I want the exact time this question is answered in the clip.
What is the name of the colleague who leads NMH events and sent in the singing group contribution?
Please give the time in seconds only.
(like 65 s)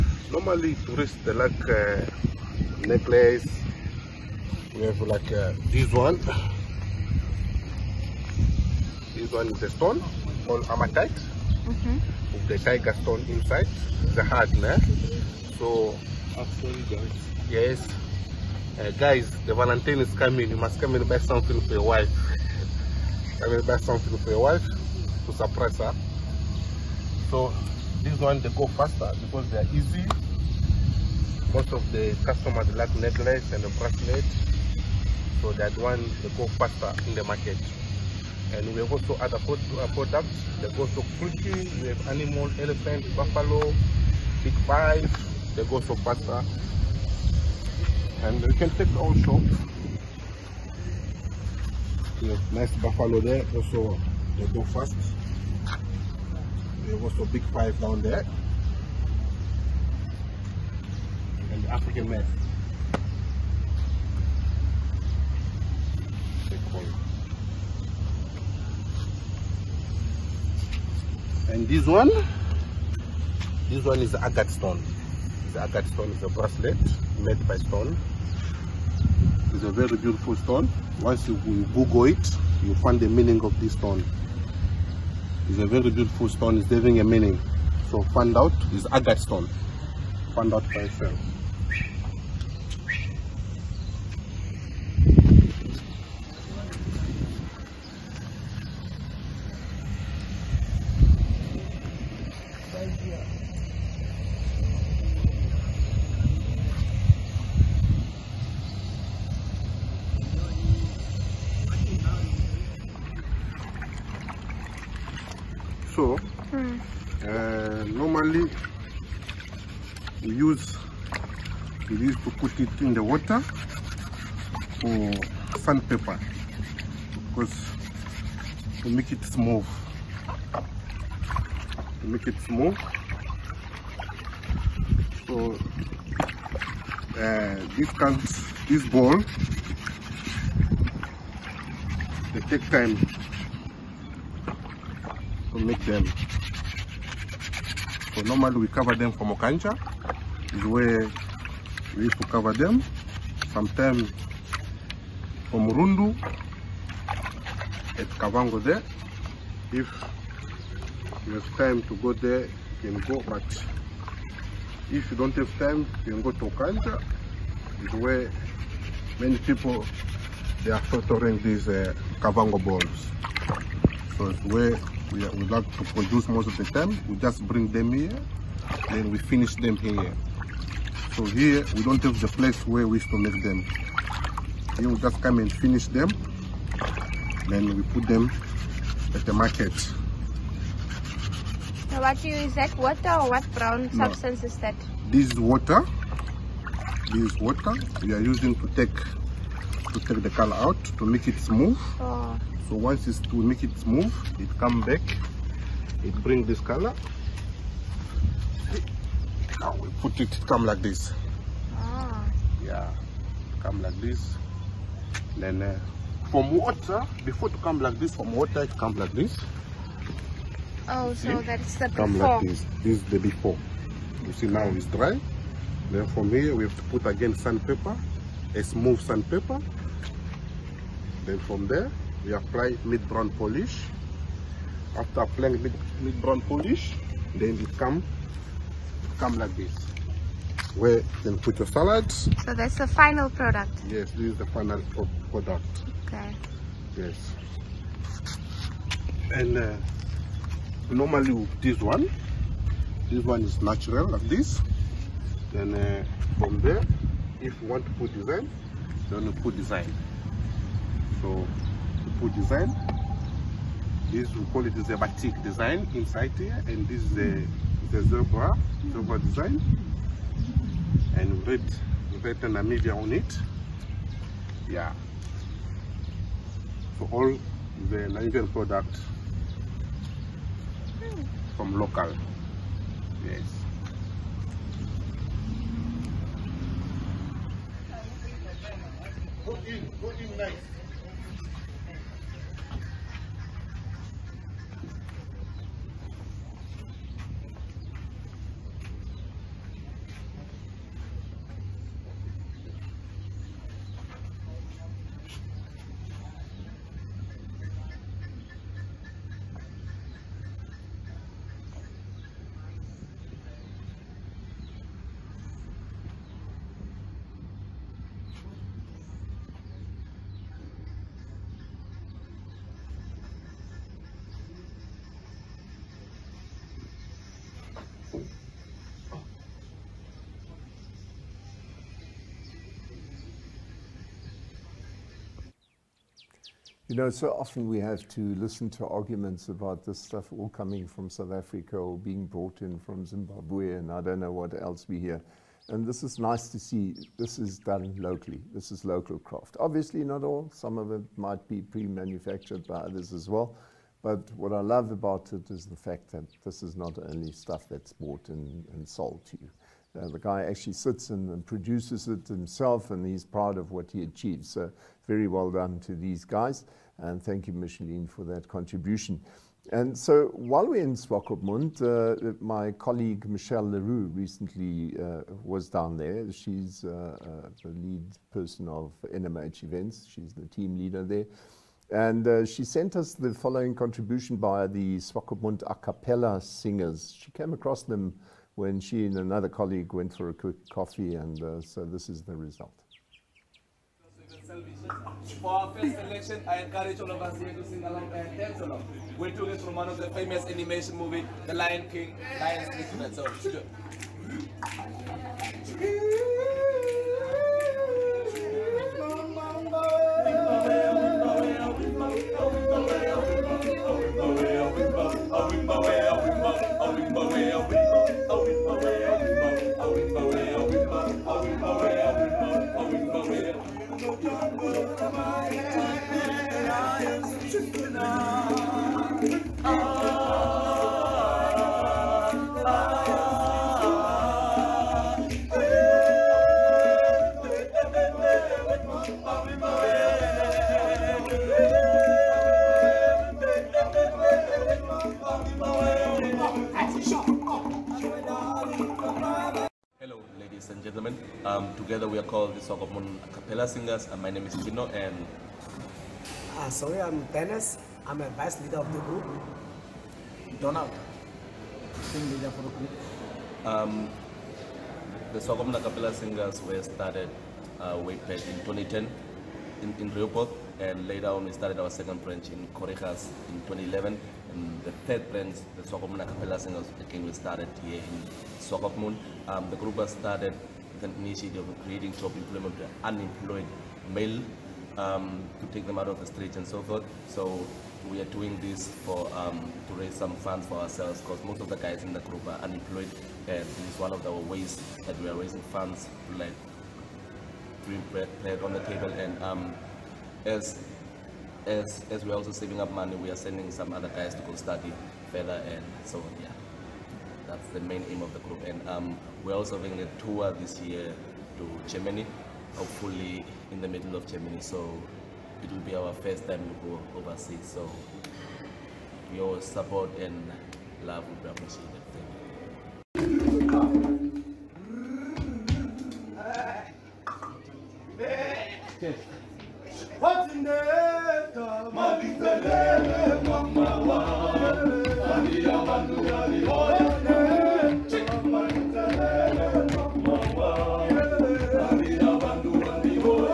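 373 s.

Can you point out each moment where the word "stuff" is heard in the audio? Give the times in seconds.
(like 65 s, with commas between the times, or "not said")
339 s, 357 s.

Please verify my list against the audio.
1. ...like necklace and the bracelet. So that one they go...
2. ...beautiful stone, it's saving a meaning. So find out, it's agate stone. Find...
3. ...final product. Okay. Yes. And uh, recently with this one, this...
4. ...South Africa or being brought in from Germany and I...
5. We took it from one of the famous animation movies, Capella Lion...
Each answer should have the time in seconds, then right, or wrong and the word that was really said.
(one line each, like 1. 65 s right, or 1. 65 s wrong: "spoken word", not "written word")
1. 32 s right
2. 85 s wrong: "having", not "saving"
3. 244 s wrong: "normally", not "recently"
4. 341 s wrong: "Zimbabwe", not "Germany"
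5. 399 s wrong: "The", not "Capella".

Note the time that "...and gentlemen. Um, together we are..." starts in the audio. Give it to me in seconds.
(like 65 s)
450 s.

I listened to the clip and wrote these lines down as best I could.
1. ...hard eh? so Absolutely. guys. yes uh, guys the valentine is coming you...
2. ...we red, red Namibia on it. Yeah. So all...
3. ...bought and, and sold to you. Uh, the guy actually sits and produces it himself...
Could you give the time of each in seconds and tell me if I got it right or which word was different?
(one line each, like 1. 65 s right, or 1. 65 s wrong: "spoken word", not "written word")
1. 14 s right
2. 271 s right
3. 357 s right.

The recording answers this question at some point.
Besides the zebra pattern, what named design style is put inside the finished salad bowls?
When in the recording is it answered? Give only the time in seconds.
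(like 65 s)
264 s.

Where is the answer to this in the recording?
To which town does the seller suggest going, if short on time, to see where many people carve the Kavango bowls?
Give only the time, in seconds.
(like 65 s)
166 s.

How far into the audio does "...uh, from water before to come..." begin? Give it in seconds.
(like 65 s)
215 s.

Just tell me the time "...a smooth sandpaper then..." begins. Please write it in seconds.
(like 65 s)
228 s.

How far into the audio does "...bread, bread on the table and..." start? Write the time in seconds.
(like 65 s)
498 s.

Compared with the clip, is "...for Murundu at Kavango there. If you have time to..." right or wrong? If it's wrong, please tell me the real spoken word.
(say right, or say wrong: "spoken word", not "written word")
right.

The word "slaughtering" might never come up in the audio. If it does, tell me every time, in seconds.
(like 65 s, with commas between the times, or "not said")
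170 s.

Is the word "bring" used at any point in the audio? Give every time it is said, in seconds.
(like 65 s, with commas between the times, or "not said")
177 s, 206 s, 497 s.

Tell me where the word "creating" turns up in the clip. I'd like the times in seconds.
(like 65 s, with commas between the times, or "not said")
481 s.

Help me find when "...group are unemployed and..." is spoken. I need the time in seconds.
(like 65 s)
492 s.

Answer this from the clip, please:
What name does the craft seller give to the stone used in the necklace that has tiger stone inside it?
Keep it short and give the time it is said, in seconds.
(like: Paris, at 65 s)
amatite, at 10 s.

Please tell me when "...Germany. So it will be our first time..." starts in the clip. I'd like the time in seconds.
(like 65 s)
514 s.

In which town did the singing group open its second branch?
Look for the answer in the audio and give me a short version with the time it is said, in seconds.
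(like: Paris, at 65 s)
Khorixas, at 472 s.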